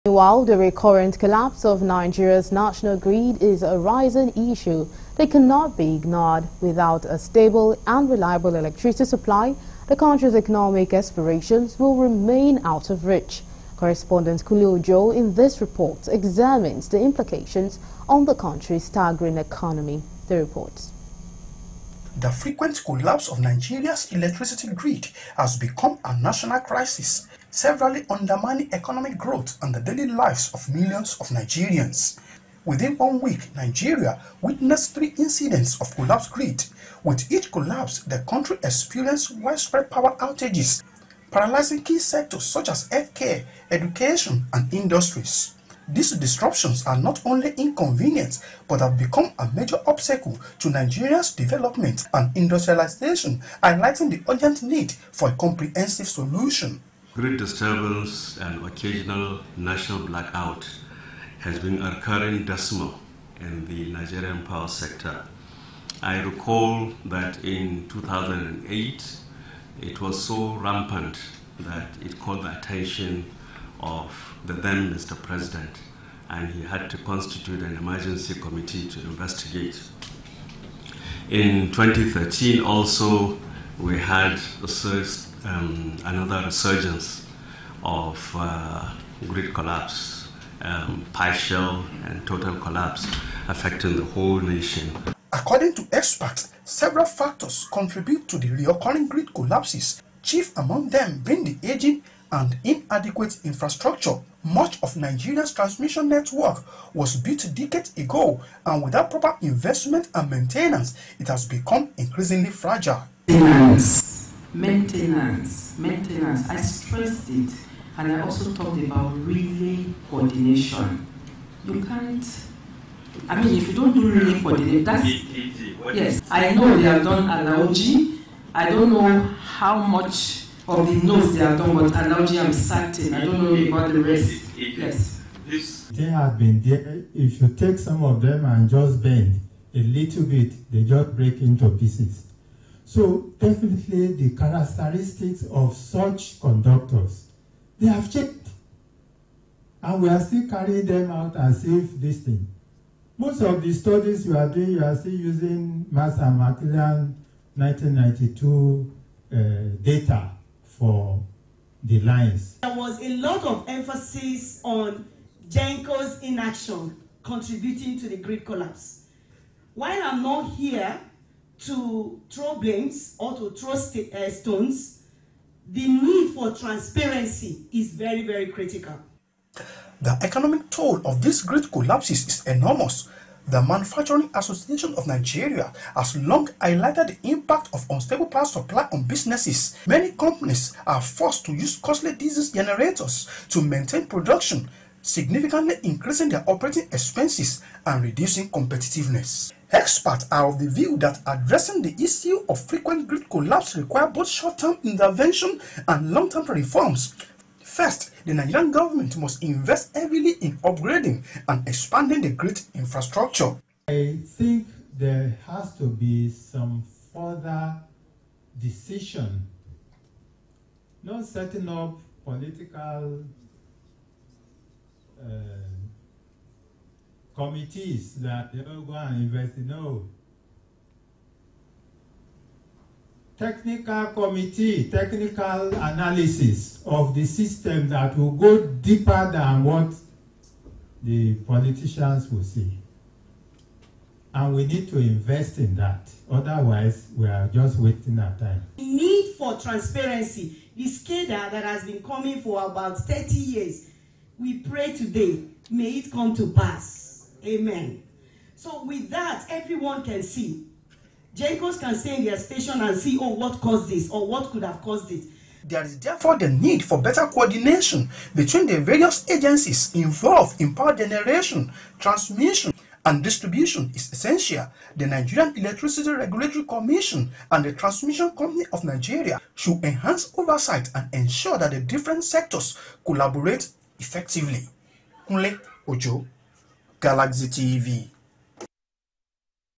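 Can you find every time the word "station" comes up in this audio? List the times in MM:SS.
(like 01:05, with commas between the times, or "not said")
04:22.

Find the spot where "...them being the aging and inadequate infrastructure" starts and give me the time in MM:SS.
01:40.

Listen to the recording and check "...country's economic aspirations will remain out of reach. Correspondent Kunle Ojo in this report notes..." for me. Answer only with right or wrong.
wrong.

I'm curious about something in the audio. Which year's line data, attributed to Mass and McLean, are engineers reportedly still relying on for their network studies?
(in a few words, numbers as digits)
1992.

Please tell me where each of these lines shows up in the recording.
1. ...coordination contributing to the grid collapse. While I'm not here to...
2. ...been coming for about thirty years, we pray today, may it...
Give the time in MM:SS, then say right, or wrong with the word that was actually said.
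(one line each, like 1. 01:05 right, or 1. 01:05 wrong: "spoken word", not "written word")
1. 02:46 wrong: "inaction", not "coordination"
2. 04:11 right.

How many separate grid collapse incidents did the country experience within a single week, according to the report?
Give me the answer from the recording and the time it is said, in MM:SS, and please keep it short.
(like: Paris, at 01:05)
3, at 00:34.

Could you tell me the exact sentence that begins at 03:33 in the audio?
I think there has to be some further decision, not setting up political uh, committees that they know, go and invest.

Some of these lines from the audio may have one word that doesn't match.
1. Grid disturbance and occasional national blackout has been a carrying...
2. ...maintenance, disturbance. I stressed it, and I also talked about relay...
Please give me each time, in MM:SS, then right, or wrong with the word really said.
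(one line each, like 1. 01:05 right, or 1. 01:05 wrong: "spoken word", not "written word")
1. 00:57 wrong: "recurring", not "carrying"
2. 01:54 wrong: "maintenance", not "disturbance".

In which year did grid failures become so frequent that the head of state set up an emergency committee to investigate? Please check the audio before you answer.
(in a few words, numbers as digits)
2008.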